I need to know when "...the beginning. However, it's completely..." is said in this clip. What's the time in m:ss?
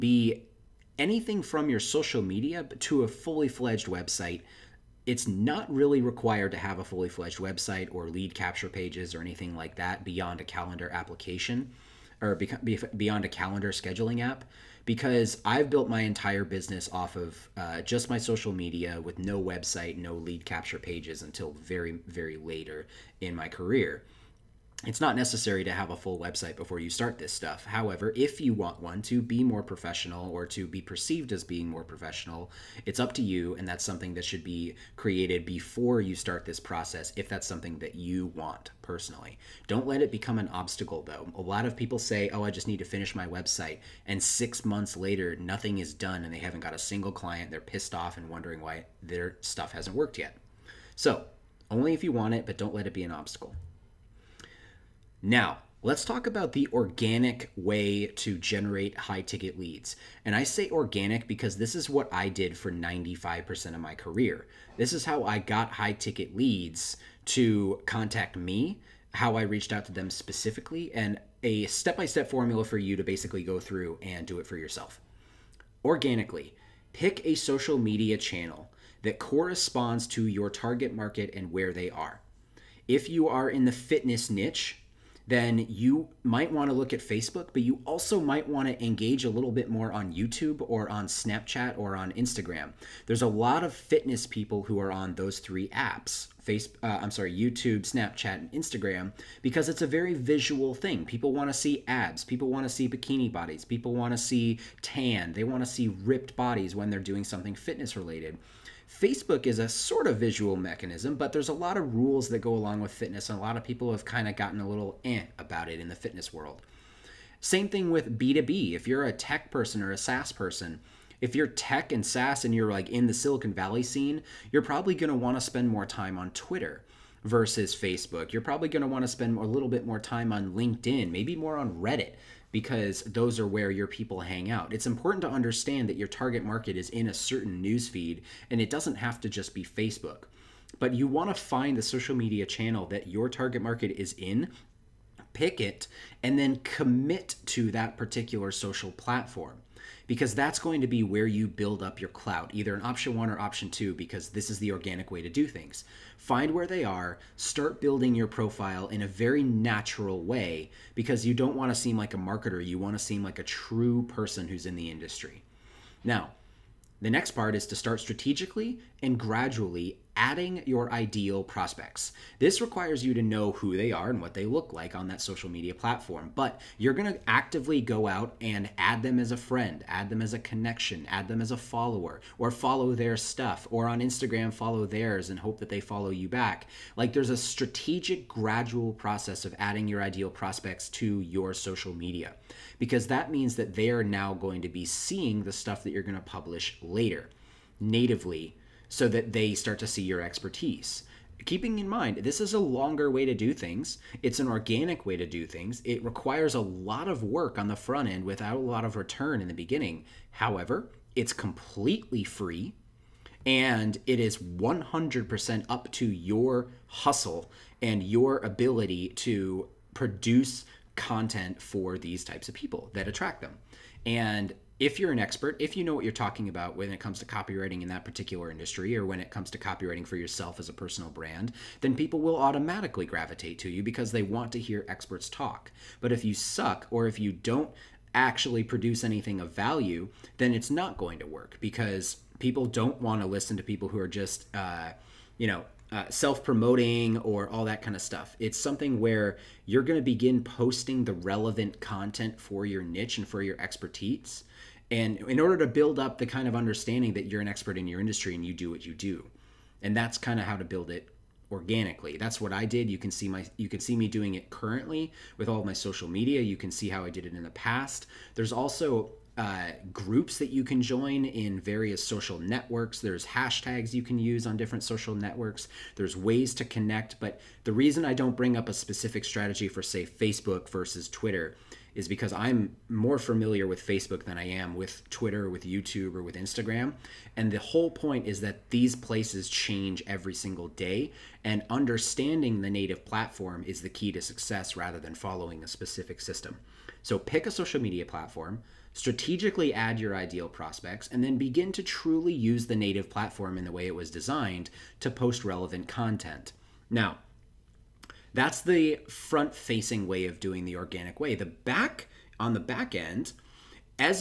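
3:29.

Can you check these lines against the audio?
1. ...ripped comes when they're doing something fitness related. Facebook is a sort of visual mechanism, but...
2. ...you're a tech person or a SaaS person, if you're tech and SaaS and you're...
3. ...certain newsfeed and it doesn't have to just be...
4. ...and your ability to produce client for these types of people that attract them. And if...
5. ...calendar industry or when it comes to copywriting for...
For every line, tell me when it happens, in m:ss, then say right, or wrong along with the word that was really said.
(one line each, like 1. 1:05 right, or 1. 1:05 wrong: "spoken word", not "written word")
1. 1:46 wrong: "bodies", not "comes"
2. 1:58 right
3. 2:17 right
4. 3:37 wrong: "content", not "client"
5. 3:48 wrong: "particular", not "calendar".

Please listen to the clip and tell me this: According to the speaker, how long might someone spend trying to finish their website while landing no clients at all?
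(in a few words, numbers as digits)
six months.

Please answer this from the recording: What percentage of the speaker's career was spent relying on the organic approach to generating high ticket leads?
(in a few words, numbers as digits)
95%.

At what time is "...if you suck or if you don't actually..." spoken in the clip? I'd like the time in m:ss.
3:56.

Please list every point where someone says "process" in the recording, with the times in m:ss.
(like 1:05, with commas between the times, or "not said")
0:36, 3:08.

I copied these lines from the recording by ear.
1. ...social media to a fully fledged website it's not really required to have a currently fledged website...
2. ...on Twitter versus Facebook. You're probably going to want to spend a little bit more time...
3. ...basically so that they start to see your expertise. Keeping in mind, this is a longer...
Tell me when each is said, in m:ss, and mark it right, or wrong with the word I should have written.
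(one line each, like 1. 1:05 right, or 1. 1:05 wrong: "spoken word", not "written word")
1. 0:01 wrong: "fully", not "currently"
2. 2:06 right
3. 3:17 wrong: "natively", not "basically".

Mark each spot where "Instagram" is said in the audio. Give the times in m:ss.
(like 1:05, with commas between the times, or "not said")
1:32, 1:38, 3:03, 4:46.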